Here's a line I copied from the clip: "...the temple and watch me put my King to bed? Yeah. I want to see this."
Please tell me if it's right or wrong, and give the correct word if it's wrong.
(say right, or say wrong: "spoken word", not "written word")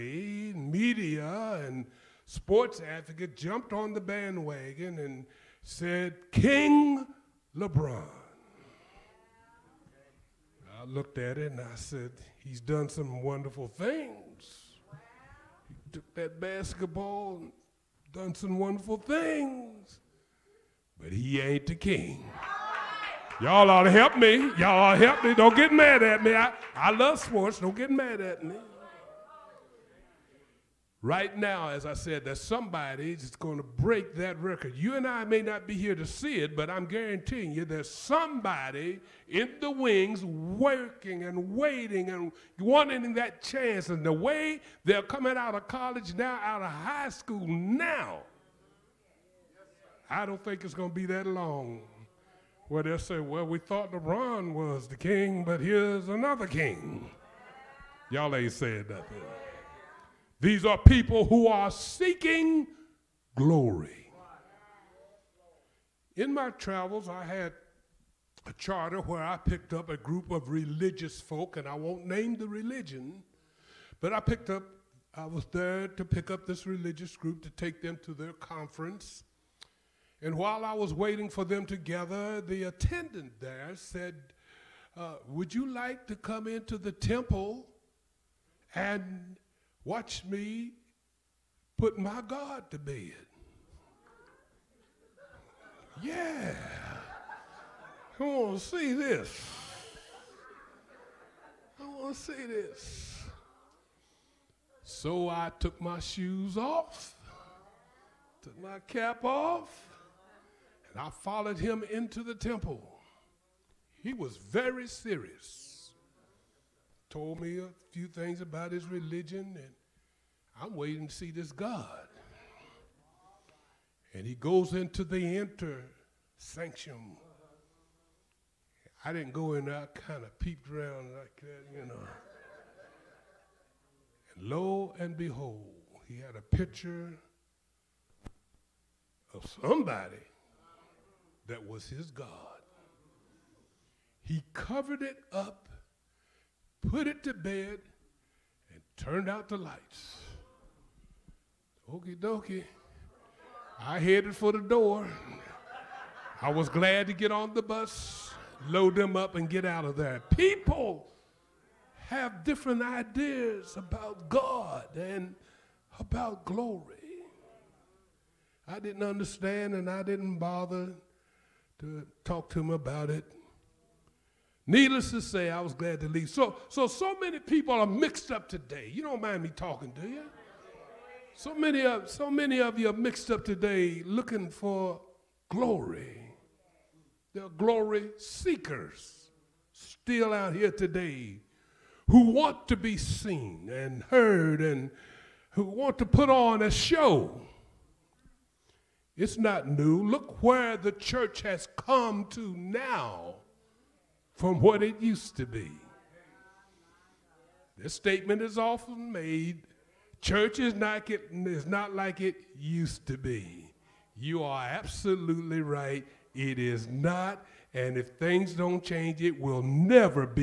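wrong: "God", not "King".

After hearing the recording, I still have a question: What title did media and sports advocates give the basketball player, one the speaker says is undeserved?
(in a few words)
King LeBron.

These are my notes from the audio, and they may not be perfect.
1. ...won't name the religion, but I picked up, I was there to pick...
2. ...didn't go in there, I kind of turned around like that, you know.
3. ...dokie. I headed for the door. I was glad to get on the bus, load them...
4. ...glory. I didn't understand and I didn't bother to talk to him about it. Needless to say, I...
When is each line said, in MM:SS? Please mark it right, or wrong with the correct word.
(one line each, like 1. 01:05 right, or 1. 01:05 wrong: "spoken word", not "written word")
1. 01:11 right
2. 02:09 wrong: "peeped", not "turned"
3. 02:32 right
4. 02:46 right.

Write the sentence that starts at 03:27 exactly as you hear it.
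This statement is often made church is not, it, is not like it used to be.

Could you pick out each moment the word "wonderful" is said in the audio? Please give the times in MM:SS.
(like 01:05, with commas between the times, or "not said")
00:13, 00:18.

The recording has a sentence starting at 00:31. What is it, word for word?
Right now, as I said, there's somebody that's going to break that record.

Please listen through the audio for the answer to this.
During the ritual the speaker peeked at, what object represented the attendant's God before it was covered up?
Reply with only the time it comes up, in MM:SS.
02:16.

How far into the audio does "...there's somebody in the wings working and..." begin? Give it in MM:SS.
00:37.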